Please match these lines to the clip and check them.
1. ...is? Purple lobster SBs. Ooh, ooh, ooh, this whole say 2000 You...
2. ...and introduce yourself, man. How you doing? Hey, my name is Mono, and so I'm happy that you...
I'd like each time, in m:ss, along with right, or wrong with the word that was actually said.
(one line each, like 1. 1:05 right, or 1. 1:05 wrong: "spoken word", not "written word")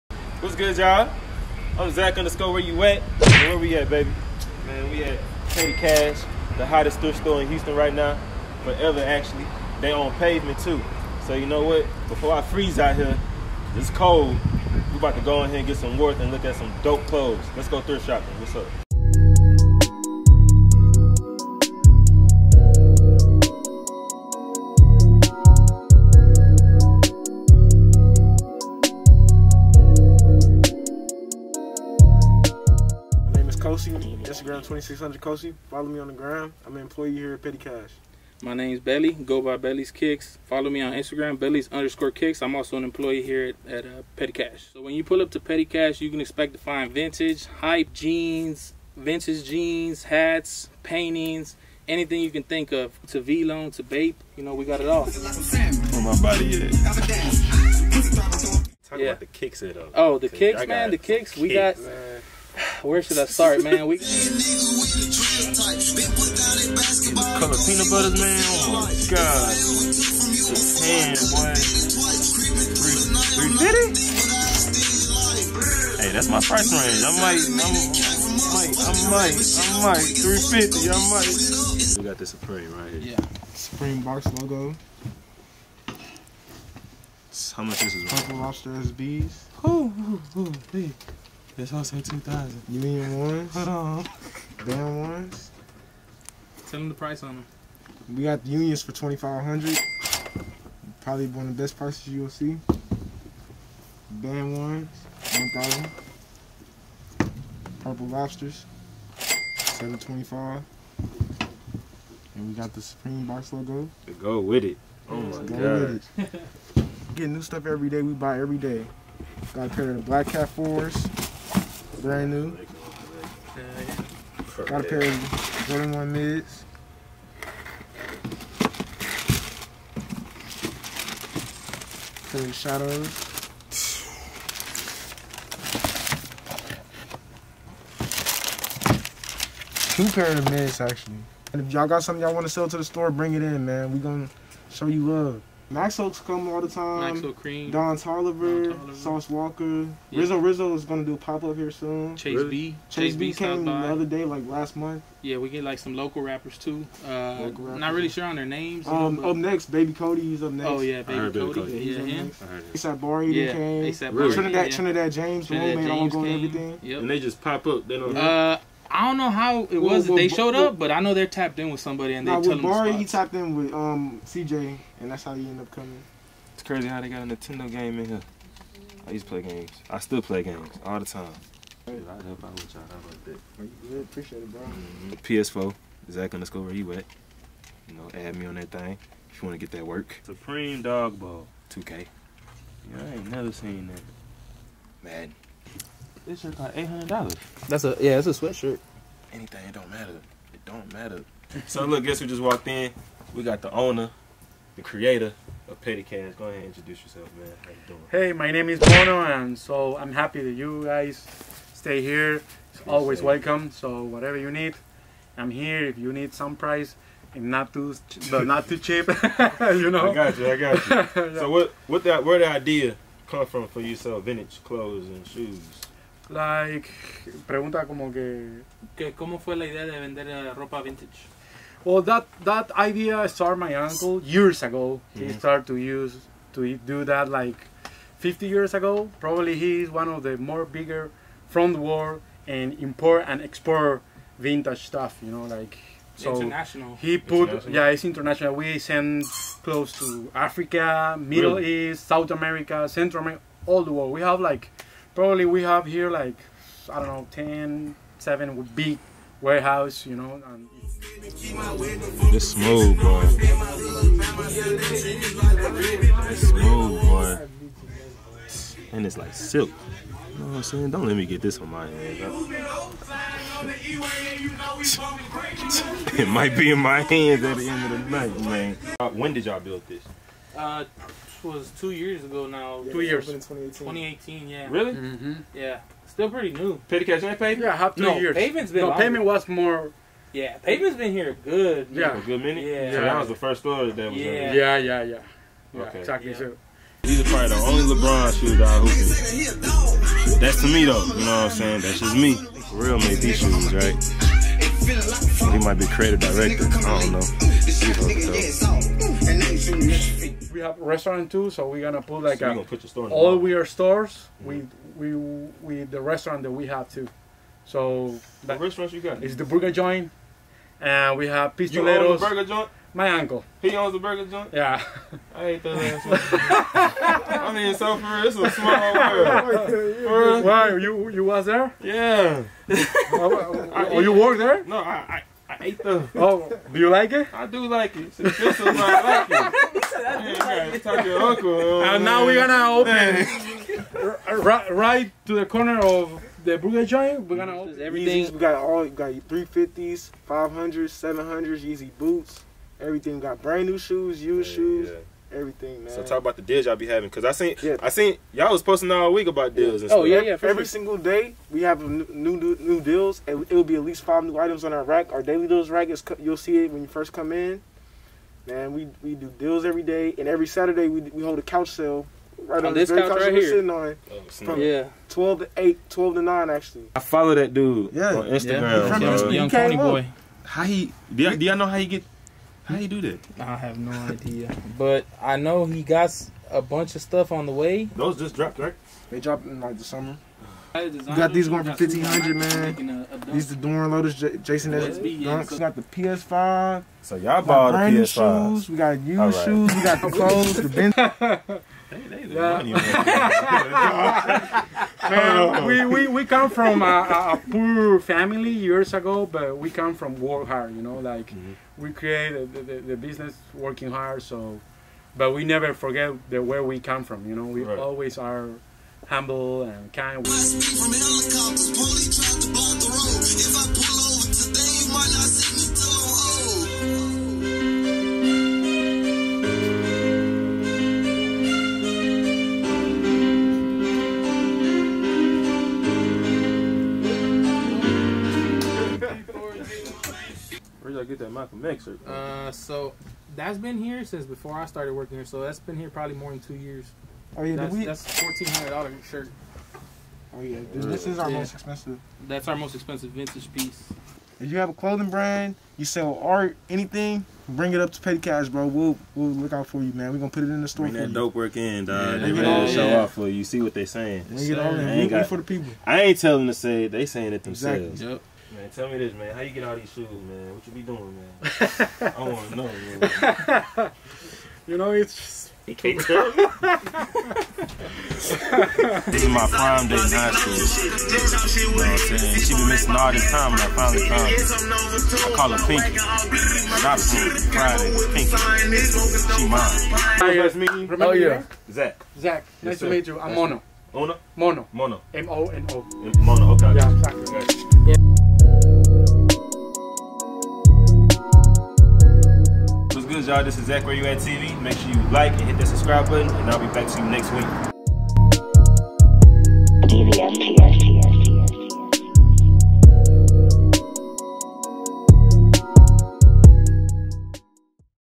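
1. 1:27 right
2. 3:26 right.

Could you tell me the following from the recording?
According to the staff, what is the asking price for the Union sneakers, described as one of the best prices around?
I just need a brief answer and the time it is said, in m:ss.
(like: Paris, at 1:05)
2500, at 1:38.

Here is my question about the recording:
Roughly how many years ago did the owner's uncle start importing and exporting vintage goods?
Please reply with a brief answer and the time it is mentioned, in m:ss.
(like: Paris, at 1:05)
50 years, at 3:58.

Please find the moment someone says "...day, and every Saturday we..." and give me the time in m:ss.
6:09.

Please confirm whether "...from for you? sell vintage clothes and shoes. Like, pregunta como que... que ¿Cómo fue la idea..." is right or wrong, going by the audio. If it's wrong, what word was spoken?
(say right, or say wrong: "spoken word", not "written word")
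right.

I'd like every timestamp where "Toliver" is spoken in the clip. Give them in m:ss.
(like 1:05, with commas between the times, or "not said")
2:27.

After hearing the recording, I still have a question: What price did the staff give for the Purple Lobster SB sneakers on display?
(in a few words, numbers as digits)
725.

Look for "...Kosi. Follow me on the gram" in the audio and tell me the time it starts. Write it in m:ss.
0:35.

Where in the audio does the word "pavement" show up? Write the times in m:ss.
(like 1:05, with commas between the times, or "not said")
0:10, 4:50.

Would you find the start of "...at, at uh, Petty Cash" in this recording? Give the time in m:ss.
0:43.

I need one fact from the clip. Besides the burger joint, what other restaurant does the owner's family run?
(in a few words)
Pistoleros.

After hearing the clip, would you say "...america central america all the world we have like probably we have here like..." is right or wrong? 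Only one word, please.
right.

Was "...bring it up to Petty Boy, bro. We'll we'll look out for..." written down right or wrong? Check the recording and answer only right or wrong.
wrong.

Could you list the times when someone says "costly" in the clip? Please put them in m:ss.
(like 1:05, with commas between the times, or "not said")
not said.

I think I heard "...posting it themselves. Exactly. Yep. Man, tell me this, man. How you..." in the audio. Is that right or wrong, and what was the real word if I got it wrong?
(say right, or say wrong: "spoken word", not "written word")
wrong: "saying", not "posting".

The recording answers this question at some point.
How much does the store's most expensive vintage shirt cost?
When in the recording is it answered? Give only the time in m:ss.
7:28.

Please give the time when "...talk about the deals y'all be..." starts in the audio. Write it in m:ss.
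5:56.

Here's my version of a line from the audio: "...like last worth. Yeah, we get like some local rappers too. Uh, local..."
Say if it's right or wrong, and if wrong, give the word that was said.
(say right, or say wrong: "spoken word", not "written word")
wrong: "month", not "worth".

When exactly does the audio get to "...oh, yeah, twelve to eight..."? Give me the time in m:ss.
6:14.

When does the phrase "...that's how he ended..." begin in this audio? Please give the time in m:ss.
2:55.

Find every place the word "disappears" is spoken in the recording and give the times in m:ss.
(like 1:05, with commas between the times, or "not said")
not said.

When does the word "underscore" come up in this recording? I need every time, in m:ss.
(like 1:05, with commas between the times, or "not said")
0:02, 0:41, 3:06.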